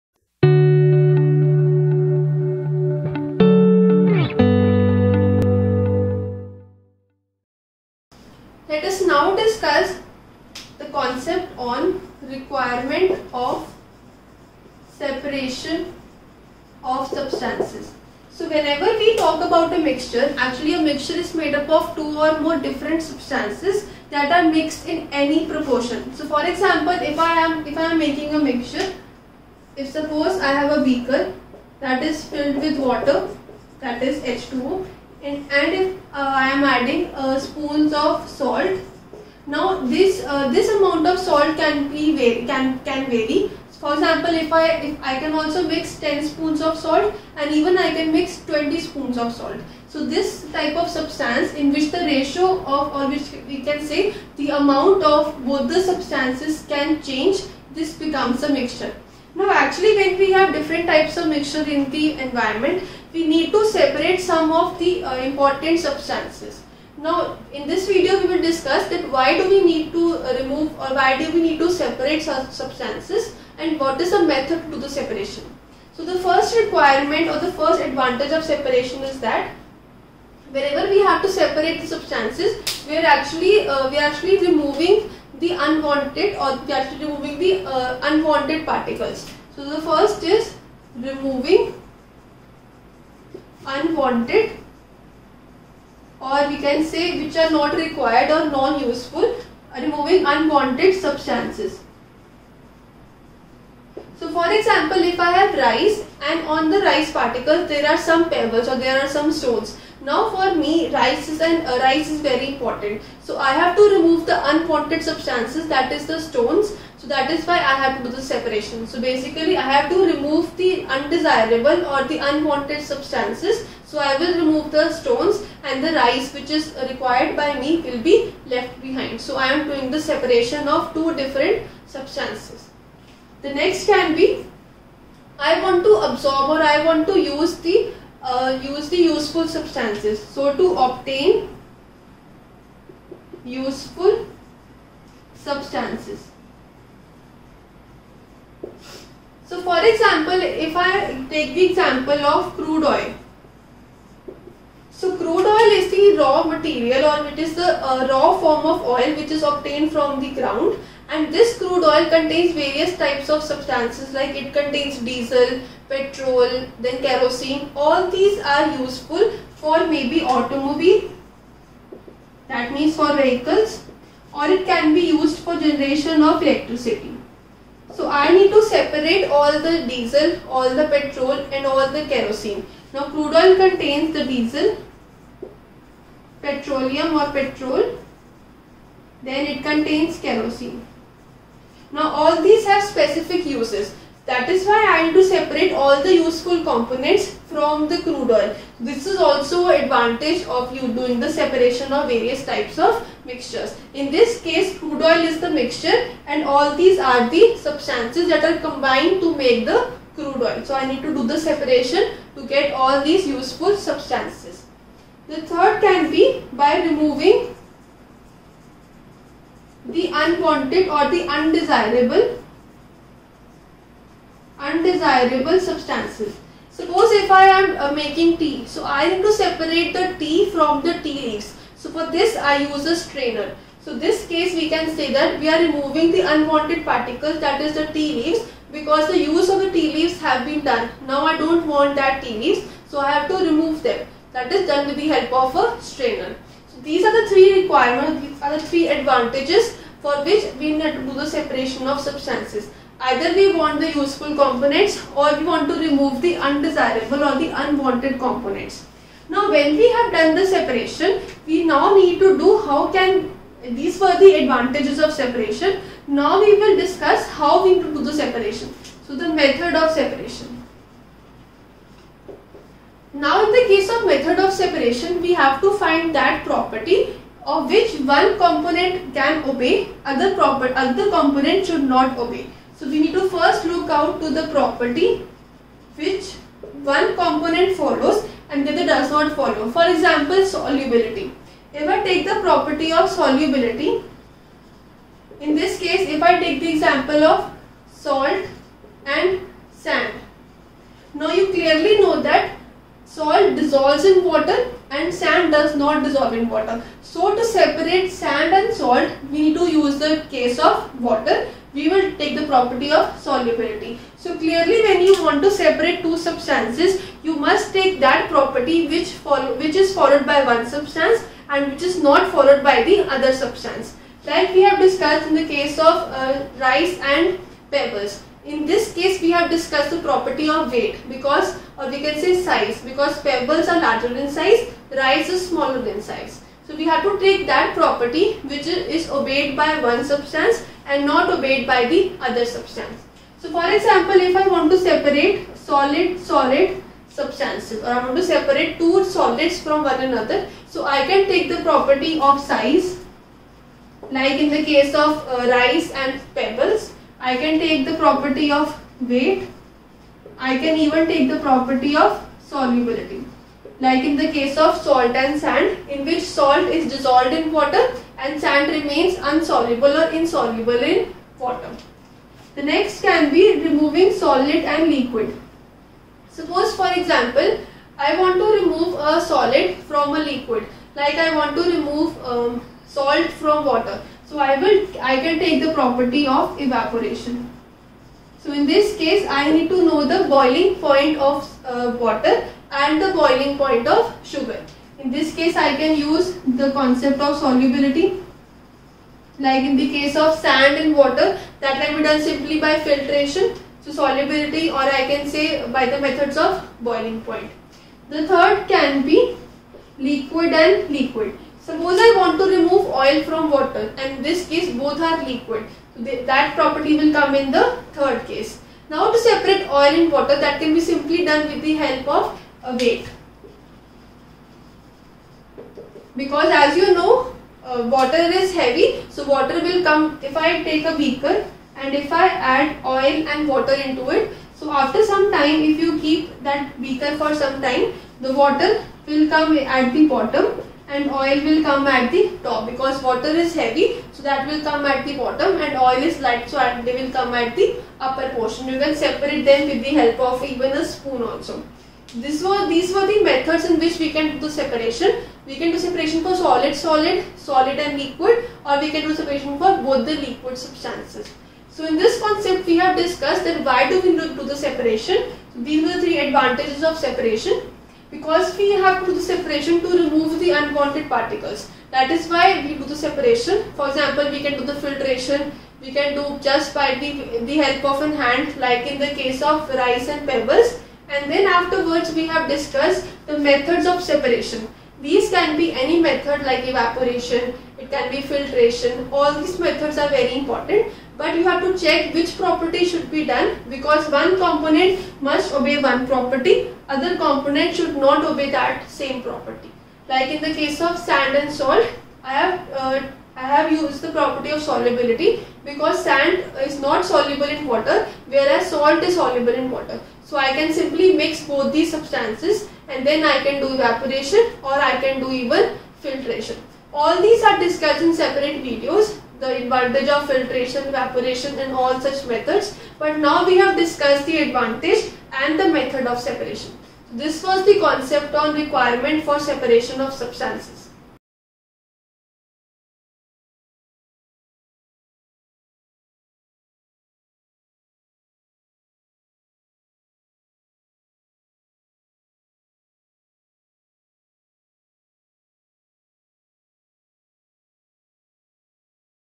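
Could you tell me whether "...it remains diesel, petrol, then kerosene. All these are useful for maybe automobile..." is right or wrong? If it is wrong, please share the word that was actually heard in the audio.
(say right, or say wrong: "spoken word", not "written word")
wrong: "contains", not "remains".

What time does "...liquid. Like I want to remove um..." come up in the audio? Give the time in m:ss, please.
6:20.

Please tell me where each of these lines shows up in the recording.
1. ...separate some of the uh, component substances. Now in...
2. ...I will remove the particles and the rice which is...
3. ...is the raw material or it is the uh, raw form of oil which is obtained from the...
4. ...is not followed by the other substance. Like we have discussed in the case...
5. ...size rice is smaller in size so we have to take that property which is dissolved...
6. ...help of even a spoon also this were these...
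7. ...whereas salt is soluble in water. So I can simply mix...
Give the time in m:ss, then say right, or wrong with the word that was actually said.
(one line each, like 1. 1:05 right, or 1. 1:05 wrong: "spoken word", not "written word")
1. 1:03 wrong: "important", not "component"
2. 2:03 wrong: "stones", not "particles"
3. 2:35 right
4. 5:21 right
5. 5:34 wrong: "obeyed", not "dissolved"
6. 7:29 right
7. 8:28 right.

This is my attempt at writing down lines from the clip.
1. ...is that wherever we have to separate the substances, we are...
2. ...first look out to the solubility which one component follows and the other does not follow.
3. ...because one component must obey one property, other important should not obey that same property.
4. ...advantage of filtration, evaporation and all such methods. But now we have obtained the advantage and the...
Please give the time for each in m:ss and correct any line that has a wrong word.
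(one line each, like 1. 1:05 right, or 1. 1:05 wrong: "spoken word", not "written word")
1. 1:19 right
2. 4:43 wrong: "property", not "solubility"
3. 8:13 wrong: "component", not "important"
4. 8:39 wrong: "discussed", not "obtained".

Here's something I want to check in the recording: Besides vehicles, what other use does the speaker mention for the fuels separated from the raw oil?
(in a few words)
generation of electricity.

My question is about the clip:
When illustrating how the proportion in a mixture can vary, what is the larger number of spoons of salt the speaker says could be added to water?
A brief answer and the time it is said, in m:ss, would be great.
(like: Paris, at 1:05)
20, at 0:48.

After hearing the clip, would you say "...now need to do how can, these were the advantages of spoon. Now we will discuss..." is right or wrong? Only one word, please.
wrong.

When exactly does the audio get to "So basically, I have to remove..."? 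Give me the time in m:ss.
1:58.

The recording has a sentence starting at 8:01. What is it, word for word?
And then afterwards we have discussed the methods of separation.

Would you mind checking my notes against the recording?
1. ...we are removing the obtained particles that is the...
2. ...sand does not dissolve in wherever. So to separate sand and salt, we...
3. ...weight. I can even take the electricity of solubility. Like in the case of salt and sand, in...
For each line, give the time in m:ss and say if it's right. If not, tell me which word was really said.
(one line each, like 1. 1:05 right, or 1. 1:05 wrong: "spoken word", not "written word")
1. 3:55 wrong: "unwanted", not "obtained"
2. 5:05 wrong: "water", not "wherever"
3. 5:59 wrong: "property", not "electricity".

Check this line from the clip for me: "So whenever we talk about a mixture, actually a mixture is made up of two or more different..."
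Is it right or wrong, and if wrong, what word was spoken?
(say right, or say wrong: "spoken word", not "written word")
right.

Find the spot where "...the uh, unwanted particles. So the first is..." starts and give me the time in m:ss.
1:27.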